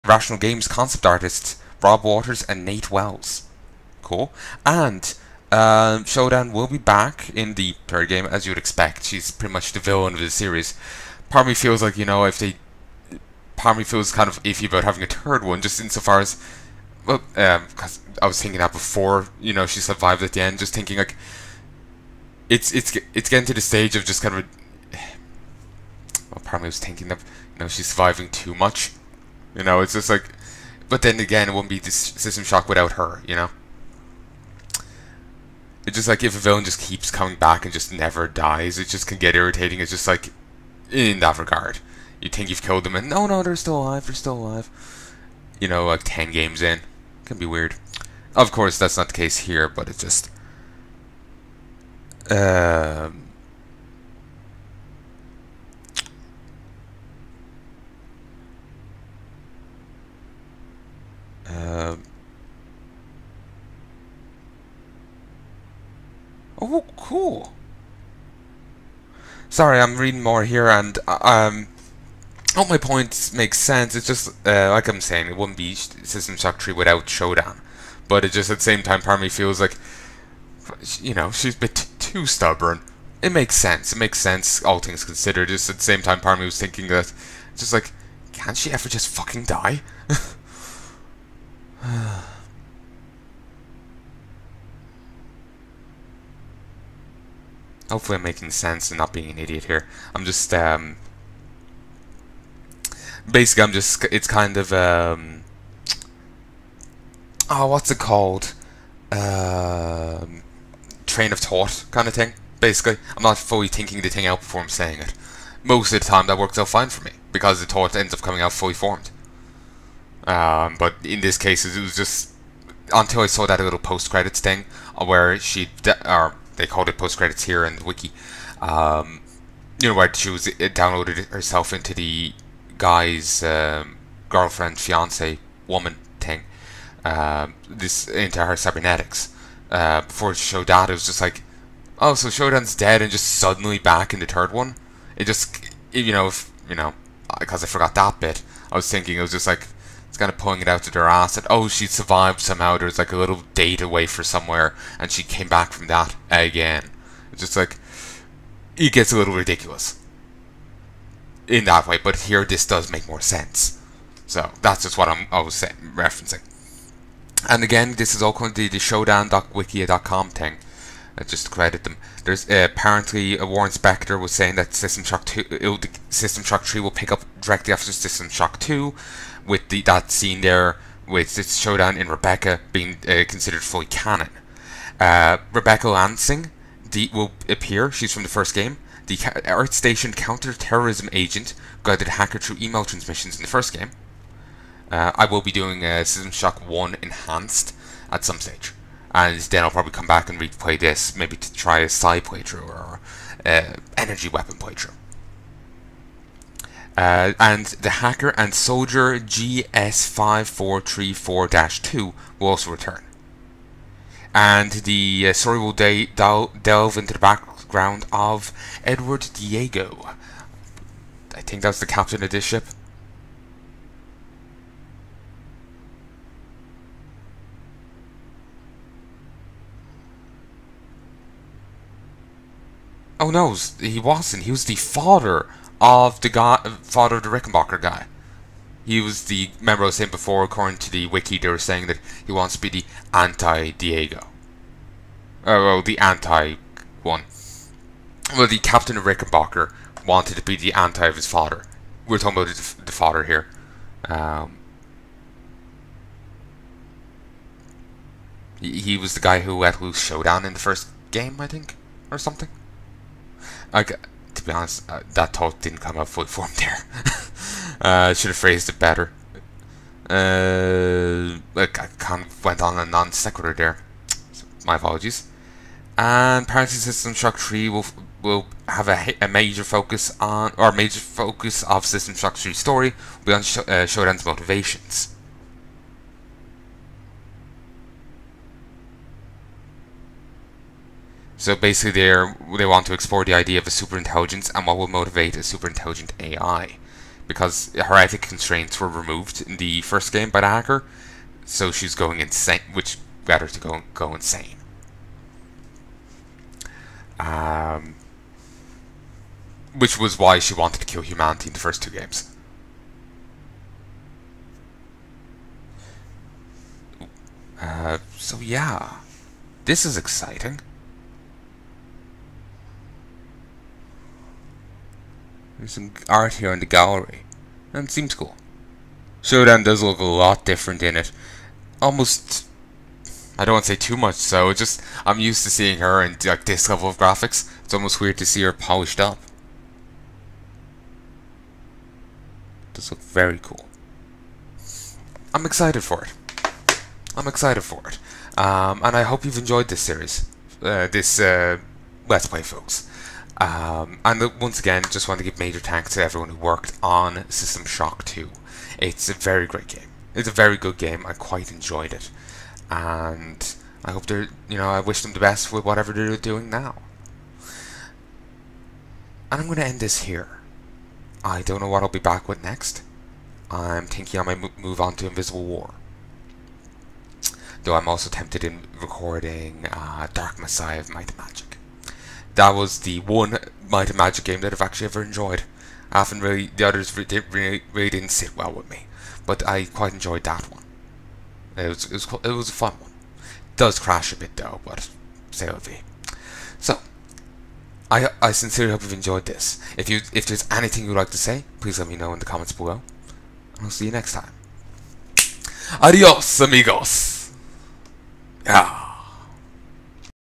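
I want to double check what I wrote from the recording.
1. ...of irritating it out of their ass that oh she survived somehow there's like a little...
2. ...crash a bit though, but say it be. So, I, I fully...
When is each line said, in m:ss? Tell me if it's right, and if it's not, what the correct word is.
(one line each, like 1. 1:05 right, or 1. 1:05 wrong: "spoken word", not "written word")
1. 2:30 wrong: "pulling", not "irritating"
2. 6:33 wrong: "sincerely", not "fully".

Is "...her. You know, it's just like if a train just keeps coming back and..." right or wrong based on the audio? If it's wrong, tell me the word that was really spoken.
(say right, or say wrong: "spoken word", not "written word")
wrong: "villain", not "train".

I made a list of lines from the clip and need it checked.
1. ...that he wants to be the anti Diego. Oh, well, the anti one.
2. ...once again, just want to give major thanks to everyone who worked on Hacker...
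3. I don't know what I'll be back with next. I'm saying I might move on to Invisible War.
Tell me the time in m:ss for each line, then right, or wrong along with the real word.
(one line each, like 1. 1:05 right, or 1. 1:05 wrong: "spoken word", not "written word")
1. 4:01 right
2. 5:54 wrong: "System", not "Hacker"
3. 6:11 wrong: "thinking", not "saying".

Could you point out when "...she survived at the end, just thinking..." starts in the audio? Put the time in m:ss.
0:19.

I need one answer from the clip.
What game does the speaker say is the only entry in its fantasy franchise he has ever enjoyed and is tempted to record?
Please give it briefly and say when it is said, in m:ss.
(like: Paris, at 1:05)
Dark Messiah of Might and Magic, at 6:20.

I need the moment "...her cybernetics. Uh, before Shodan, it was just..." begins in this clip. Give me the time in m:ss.
2:18.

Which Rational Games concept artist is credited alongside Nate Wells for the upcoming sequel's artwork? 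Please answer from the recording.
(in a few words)
Rob Waters.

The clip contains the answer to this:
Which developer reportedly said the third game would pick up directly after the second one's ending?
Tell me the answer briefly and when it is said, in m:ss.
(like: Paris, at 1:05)
Warren Spector, at 2:53.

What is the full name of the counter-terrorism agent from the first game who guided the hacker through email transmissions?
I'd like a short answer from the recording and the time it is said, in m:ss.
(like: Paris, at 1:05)
Rebecca Lansing, at 3:05.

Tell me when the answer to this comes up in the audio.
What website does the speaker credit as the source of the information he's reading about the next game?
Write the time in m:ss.
2:48.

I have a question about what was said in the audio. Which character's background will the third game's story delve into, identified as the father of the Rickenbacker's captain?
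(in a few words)
Edward Diego.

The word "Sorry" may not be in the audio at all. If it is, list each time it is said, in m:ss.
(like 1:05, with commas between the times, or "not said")
1:09.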